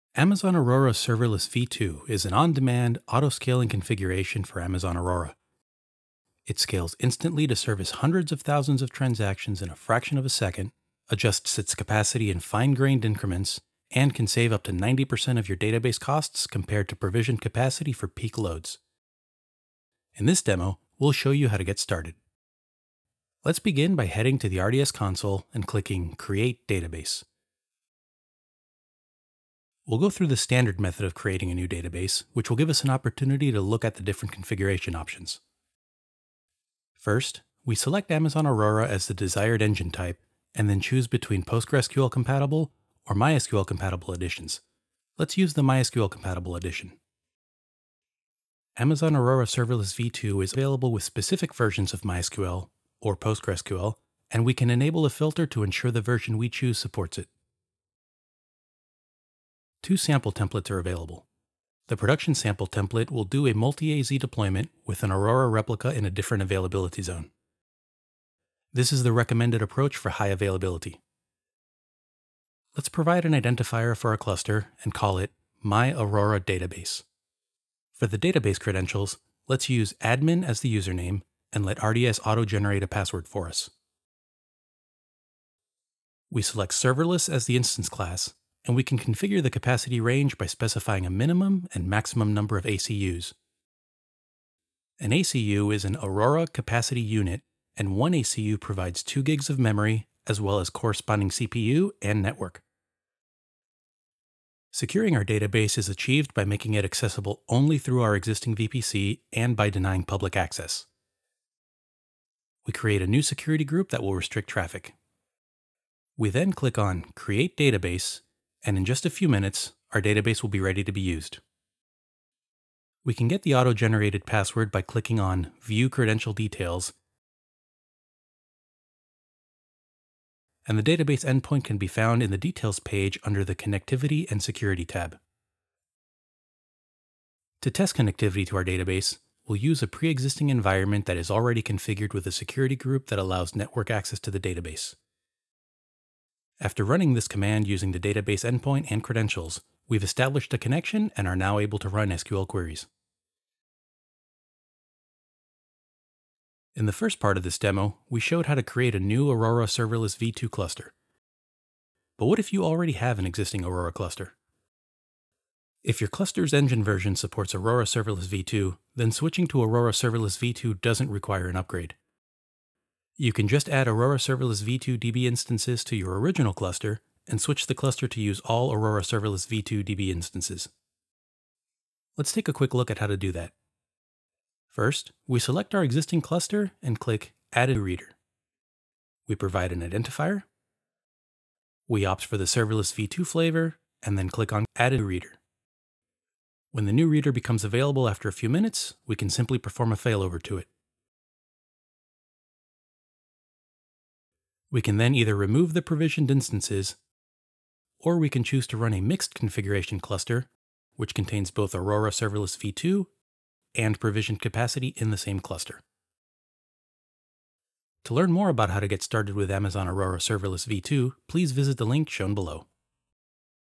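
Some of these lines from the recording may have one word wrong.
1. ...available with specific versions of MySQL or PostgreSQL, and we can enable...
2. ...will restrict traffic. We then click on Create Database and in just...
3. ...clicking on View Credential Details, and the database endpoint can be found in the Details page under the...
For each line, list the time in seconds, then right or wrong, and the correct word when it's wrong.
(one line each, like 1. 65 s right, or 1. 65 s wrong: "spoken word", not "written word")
1. 50 s right
2. 114 s right
3. 124 s right.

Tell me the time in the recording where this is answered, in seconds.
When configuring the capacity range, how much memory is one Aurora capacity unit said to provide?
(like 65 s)
99 s.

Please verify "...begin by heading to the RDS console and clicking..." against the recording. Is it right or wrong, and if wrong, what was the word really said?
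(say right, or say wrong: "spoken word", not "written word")
right.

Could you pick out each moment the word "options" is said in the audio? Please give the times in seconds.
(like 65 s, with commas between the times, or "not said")
34 s.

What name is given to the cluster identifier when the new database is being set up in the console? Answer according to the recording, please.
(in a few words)
My Aurora Database.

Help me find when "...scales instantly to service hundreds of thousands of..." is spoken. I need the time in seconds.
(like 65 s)
6 s.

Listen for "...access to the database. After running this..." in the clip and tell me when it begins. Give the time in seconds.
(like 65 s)
143 s.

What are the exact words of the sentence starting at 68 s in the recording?
This is the recommended approach for high availability.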